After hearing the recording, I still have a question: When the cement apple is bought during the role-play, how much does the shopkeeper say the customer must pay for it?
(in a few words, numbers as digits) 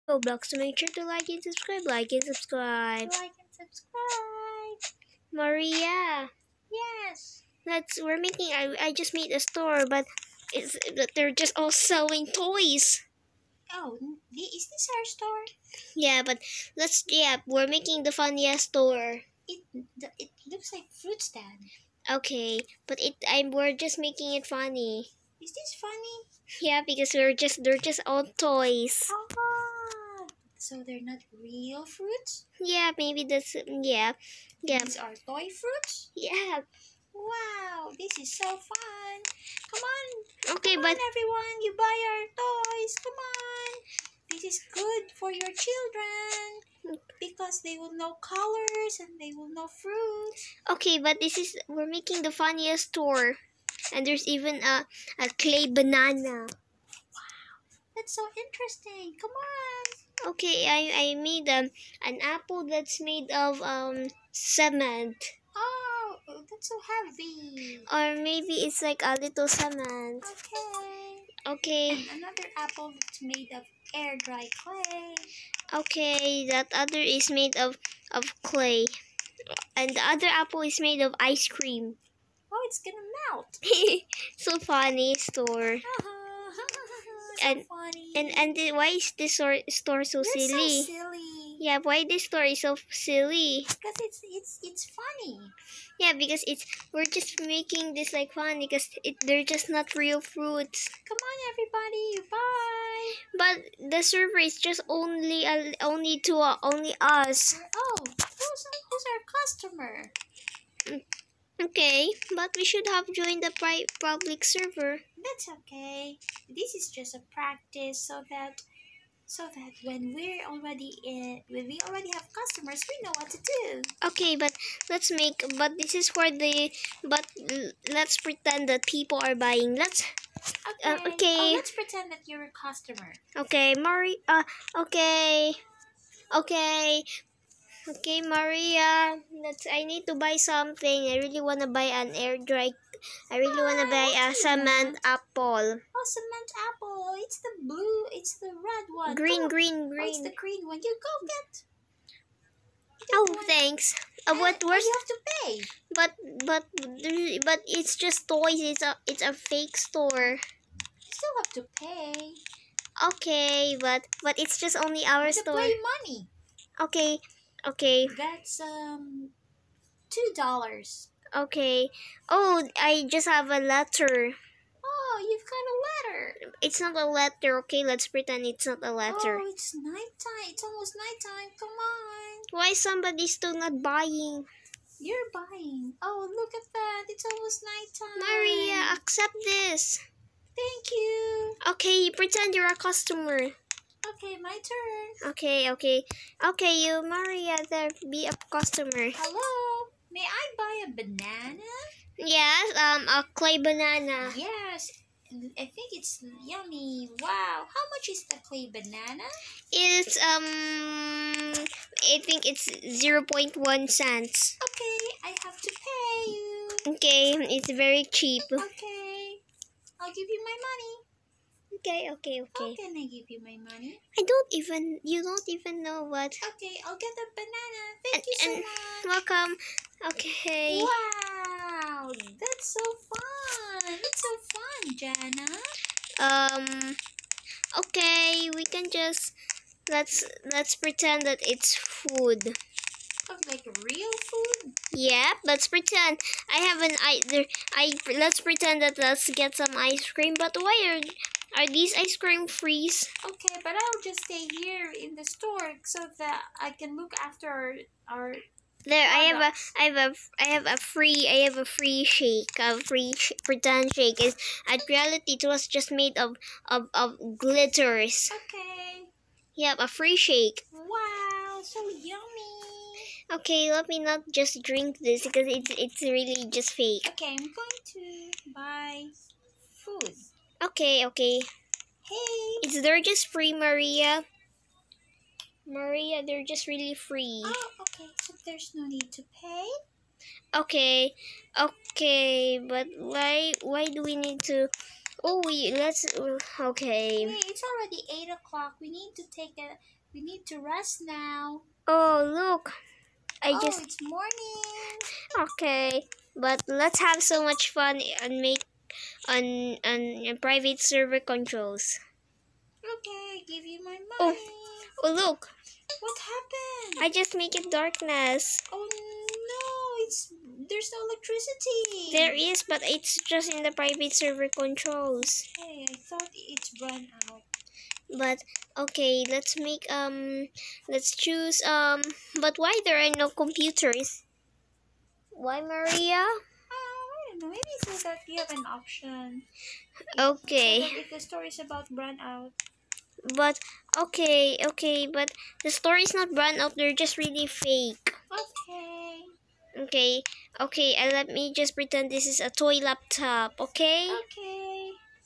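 $2.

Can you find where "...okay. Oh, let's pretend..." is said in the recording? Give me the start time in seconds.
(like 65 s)
131 s.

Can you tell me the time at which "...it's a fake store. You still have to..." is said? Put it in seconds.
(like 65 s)
159 s.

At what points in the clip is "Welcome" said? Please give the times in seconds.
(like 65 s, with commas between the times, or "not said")
229 s.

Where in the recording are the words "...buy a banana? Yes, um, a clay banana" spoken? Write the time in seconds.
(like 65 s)
200 s.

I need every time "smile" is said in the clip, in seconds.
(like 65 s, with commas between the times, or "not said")
not said.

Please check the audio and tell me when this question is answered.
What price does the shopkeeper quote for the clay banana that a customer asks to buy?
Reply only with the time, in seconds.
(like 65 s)
212 s.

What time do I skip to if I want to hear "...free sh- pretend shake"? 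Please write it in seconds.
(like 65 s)
262 s.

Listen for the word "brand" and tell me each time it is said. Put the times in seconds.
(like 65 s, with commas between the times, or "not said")
341 s, 346 s.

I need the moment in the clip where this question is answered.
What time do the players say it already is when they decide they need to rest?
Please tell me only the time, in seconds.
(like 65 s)
298 s.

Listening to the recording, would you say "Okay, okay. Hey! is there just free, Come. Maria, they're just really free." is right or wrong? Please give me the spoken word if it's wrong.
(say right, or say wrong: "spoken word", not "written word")
wrong: "Maria", not "Come".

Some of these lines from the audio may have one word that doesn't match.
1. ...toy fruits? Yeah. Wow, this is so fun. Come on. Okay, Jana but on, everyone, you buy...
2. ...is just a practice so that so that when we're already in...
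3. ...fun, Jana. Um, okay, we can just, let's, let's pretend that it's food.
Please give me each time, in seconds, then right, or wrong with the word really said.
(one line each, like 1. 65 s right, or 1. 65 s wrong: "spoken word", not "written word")
1. 35 s wrong: "Come", not "Jana"
2. 116 s right
3. 234 s right.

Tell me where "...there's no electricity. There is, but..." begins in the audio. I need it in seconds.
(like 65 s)
320 s.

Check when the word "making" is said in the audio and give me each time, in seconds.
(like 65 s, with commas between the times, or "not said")
8 s, 17 s, 23 s, 51 s, 97 s.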